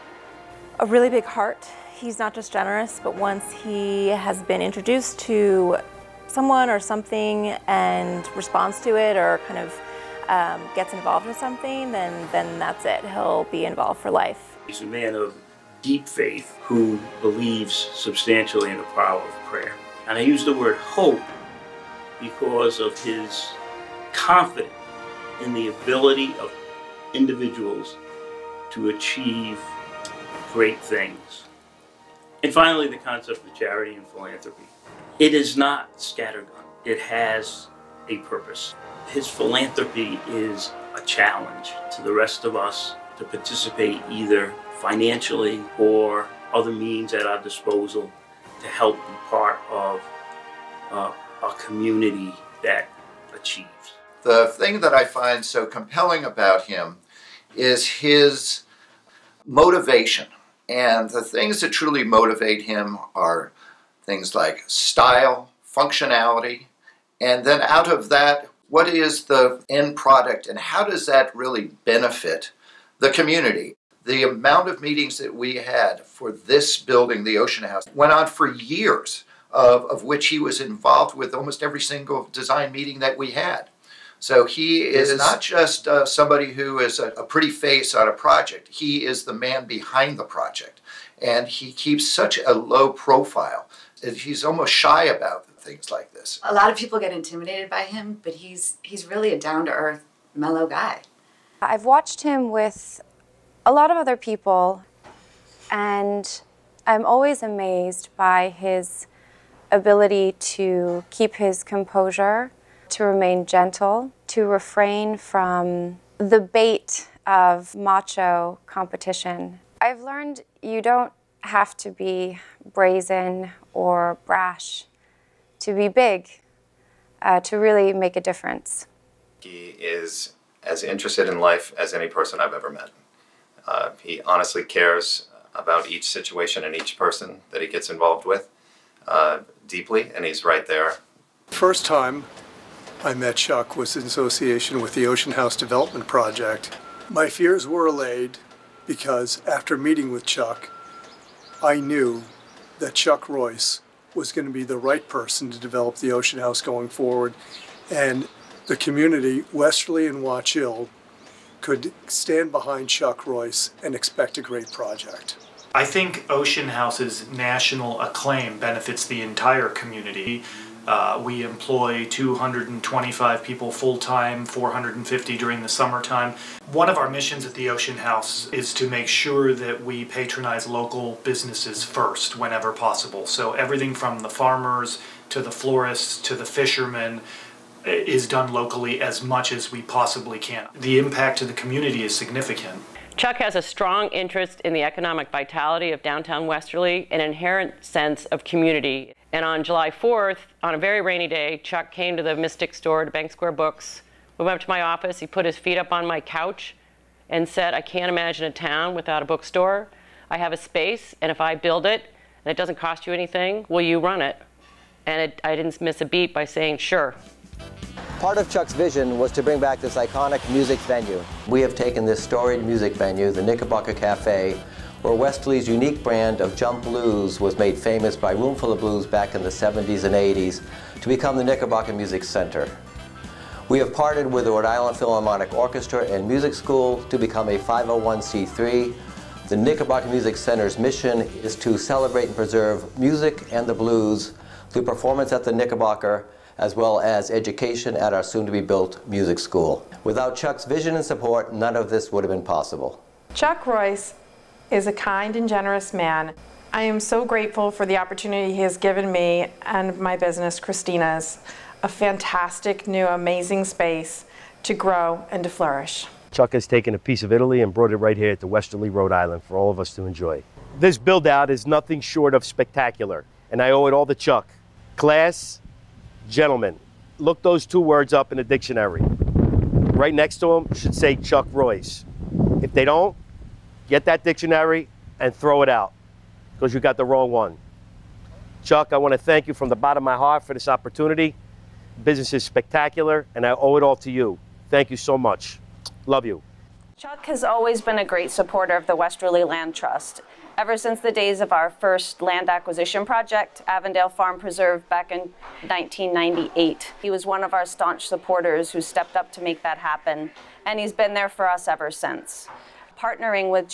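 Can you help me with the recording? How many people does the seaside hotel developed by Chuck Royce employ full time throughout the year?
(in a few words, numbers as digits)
225.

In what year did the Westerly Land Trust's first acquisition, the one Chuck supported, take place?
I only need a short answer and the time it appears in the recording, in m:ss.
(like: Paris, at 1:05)
1998, at 5:05.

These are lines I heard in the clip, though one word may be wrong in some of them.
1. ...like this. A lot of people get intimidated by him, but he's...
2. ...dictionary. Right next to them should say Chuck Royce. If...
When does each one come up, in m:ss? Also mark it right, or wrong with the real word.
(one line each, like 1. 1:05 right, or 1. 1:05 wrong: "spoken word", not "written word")
1. 1:35 right
2. 4:38 right.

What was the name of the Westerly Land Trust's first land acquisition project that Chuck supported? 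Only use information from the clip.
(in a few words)
Avondale Farm Preserve.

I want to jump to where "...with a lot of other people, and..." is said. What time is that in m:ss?
1:42.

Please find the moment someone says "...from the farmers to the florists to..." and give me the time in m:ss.
3:03.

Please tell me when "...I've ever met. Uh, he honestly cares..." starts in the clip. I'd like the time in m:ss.
2:12.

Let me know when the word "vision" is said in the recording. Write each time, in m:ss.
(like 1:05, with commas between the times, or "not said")
3:38, 4:10.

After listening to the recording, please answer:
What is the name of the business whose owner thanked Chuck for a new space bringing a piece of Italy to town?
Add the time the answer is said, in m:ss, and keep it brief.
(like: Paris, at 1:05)
Christina's, at 4:20.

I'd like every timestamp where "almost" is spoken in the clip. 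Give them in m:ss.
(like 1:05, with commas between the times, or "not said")
1:21, 1:34.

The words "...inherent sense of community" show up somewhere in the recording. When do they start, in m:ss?
3:17.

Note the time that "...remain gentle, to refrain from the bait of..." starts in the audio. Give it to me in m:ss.
1:53.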